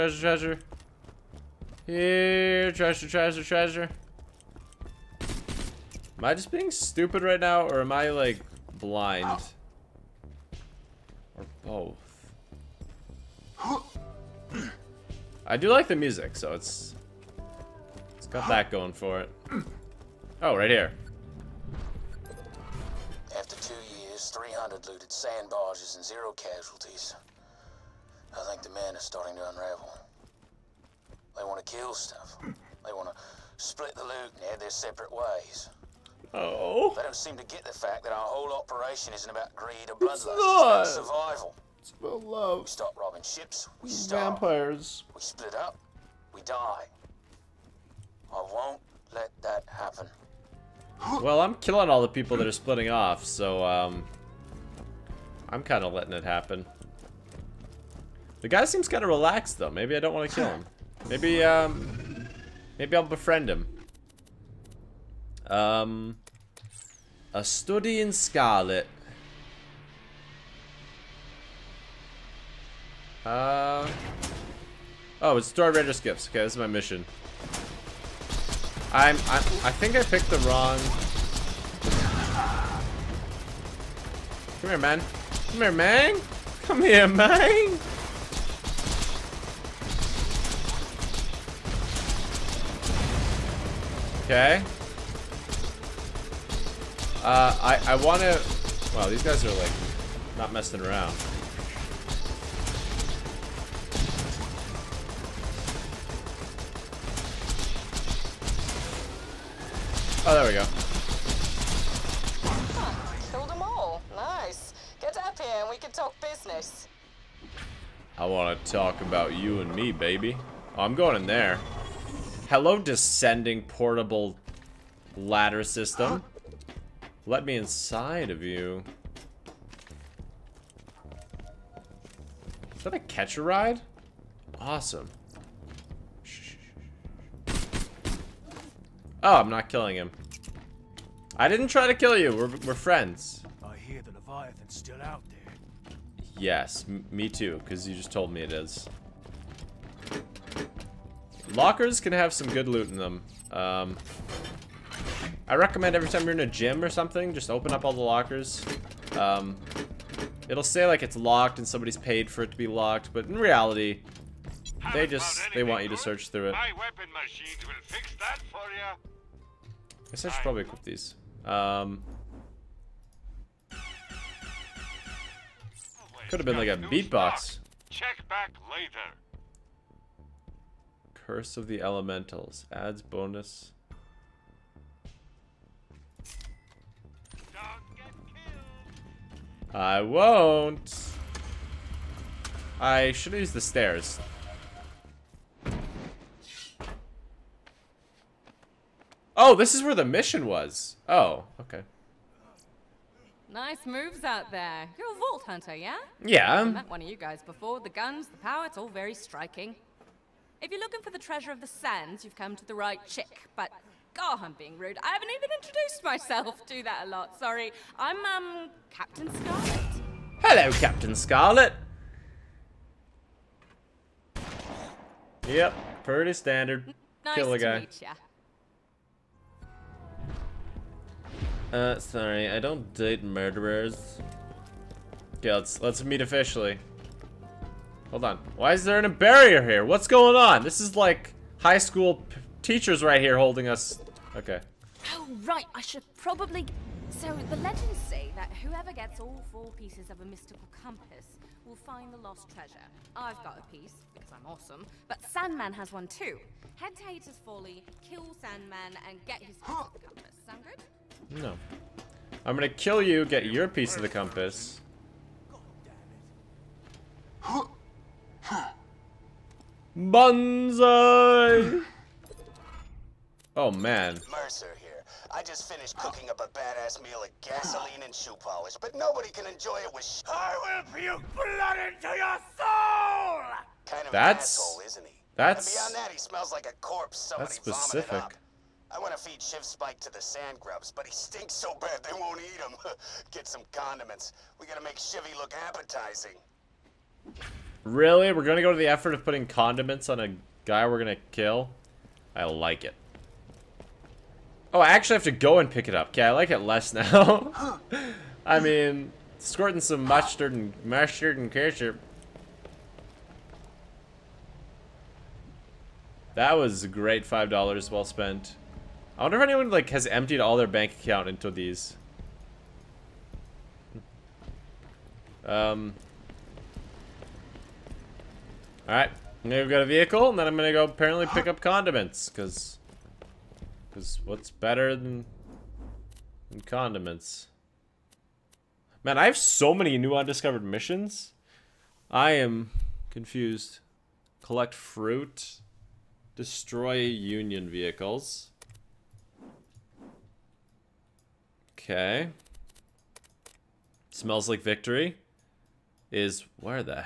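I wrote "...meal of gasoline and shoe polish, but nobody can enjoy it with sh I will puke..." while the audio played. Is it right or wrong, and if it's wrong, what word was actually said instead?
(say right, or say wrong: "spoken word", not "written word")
right.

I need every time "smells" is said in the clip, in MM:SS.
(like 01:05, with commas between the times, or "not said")
04:46, 05:54.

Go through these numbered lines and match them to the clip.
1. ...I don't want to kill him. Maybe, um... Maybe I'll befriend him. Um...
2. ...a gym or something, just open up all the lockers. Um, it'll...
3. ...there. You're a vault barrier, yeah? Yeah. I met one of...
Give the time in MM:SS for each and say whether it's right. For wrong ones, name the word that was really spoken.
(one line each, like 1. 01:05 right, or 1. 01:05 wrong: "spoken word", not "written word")
1. 00:59 right
2. 02:36 right
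3. 03:24 wrong: "hunter", not "barrier".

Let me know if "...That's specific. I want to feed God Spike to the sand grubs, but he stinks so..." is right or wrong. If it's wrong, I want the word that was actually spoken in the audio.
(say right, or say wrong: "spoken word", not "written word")
wrong: "Shiv", not "God".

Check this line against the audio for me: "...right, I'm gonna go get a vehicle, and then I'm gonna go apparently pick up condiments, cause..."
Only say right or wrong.
right.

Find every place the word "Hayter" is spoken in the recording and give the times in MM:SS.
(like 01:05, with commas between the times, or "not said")
04:17.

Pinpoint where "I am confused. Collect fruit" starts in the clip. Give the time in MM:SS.
05:42.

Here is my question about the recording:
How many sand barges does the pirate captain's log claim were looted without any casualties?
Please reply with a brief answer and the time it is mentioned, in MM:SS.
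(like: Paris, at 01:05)
300, at 00:24.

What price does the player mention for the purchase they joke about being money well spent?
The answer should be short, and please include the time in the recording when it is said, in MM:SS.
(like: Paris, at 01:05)
$5, at 05:17.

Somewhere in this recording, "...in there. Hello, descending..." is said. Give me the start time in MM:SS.
02:01.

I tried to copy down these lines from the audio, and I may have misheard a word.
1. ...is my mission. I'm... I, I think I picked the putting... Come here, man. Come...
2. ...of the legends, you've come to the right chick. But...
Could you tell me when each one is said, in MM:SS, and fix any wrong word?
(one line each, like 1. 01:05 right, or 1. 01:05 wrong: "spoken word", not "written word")
1. 01:16 wrong: "wrong", not "putting"
2. 03:31 wrong: "sands", not "legends".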